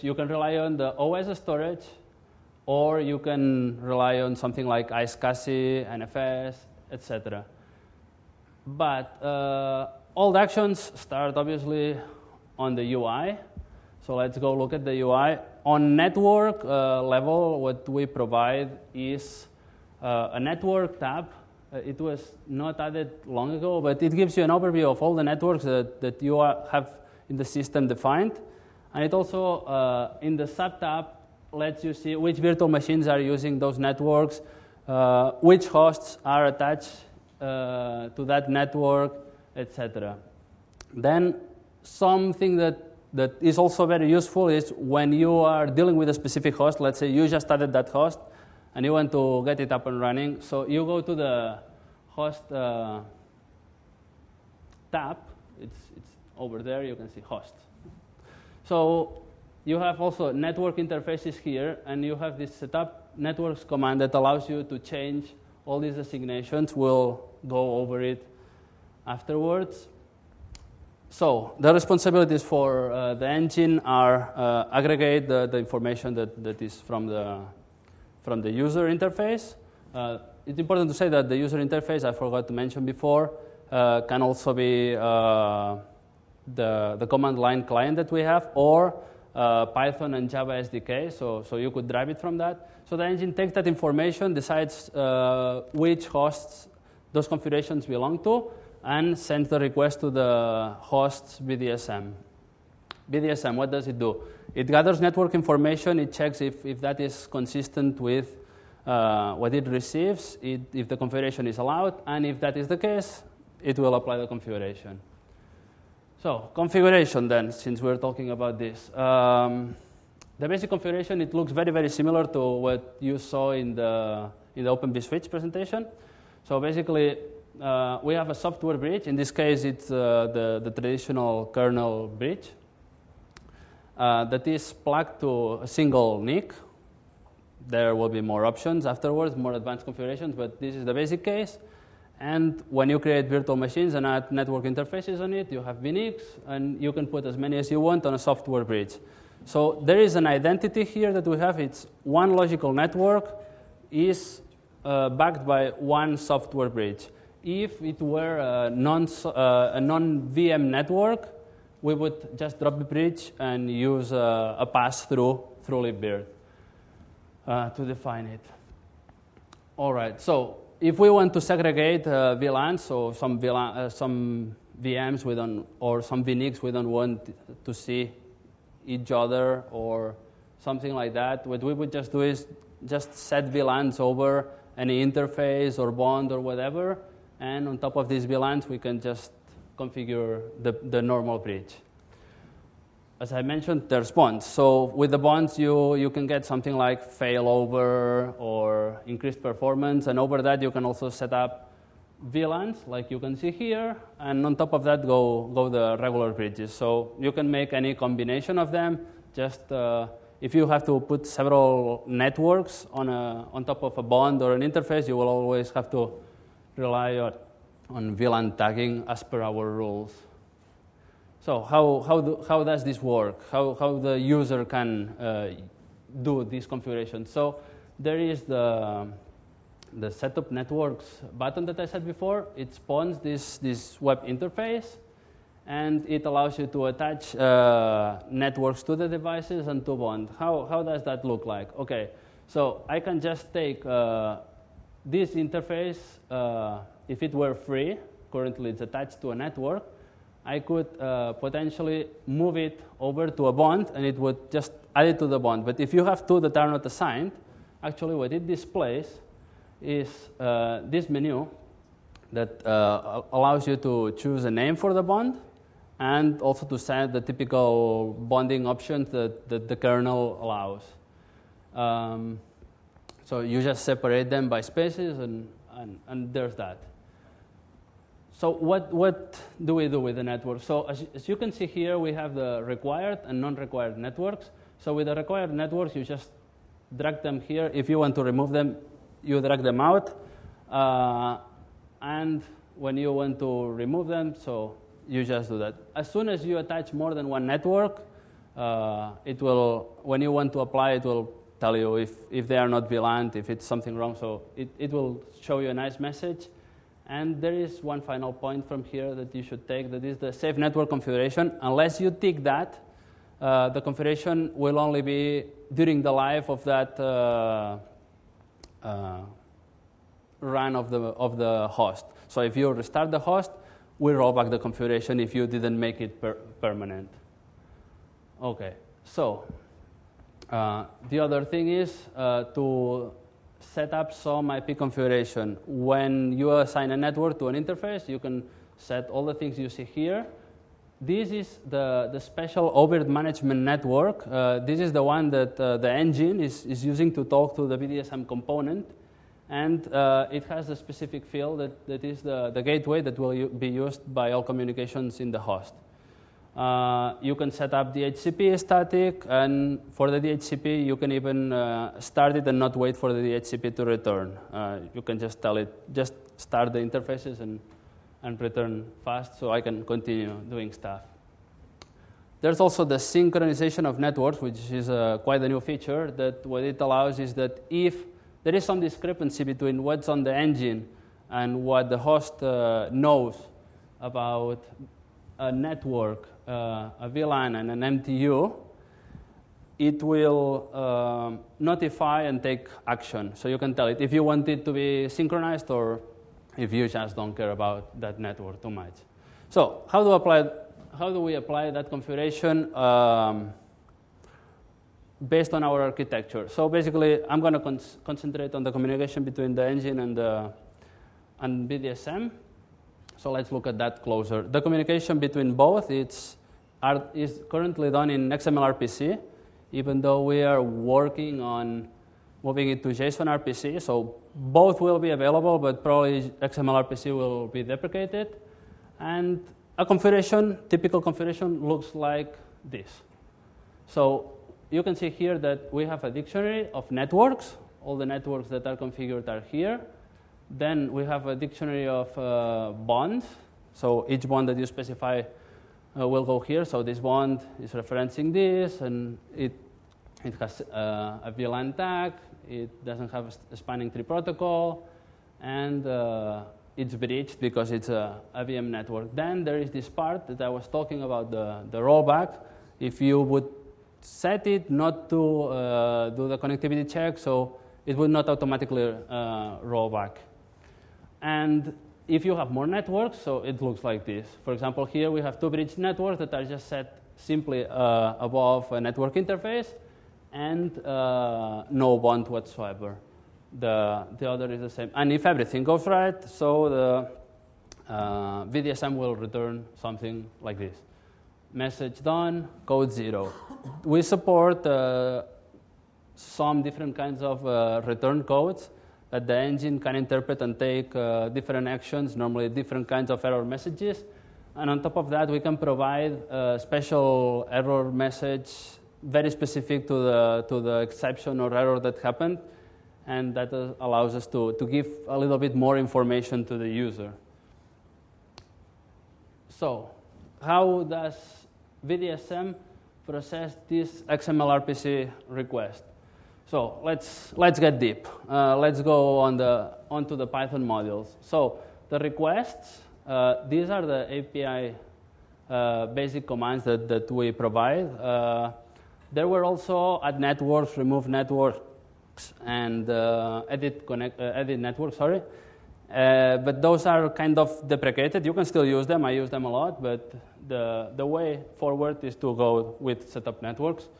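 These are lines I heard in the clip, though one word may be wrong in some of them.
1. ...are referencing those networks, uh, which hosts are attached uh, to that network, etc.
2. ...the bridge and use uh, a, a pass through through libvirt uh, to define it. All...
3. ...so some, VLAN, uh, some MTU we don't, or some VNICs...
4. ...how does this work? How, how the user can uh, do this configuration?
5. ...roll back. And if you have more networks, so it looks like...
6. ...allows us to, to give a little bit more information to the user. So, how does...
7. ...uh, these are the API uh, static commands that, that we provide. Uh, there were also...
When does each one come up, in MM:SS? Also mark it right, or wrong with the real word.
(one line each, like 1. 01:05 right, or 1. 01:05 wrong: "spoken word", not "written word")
1. 00:33 wrong: "using", not "referencing"
2. 02:42 right
3. 02:52 wrong: "VMs", not "MTU"
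4. 03:42 right
5. 07:49 right
6. 08:33 right
7. 08:53 wrong: "basic", not "static".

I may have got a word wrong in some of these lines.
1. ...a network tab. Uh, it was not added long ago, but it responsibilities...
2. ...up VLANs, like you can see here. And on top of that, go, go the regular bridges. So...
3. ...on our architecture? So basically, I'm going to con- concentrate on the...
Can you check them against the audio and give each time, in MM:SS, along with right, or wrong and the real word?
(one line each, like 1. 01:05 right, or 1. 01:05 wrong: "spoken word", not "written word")
1. 00:20 wrong: "gives", not "responsibilities"
2. 03:21 right
3. 06:45 right.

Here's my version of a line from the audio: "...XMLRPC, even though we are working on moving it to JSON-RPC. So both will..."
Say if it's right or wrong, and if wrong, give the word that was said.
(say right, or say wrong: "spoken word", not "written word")
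right.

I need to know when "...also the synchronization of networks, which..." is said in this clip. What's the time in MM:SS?
06:12.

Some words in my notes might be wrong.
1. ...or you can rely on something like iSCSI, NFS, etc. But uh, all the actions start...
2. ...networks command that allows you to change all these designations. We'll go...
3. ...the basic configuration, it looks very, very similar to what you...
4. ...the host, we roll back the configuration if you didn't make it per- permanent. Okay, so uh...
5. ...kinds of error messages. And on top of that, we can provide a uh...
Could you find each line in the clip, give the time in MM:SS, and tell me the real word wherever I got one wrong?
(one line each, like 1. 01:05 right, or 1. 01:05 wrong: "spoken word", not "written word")
1. 00:02 right
2. 01:03 right
3. 02:00 right
4. 05:23 right
5. 08:22 right.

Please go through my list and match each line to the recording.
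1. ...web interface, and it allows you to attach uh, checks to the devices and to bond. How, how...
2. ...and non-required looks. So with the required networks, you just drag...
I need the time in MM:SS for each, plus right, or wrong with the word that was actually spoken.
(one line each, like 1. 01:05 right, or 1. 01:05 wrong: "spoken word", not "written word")
1. 03:54 wrong: "networks", not "checks"
2. 04:43 wrong: "networks", not "looks".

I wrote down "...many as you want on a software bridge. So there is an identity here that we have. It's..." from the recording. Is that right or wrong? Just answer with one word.
right.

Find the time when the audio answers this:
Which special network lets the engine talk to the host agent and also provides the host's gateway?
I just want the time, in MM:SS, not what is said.
05:42.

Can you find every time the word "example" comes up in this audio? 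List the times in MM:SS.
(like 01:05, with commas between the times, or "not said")
07:54.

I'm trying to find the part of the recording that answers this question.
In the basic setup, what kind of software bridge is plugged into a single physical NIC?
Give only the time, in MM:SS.
02:10.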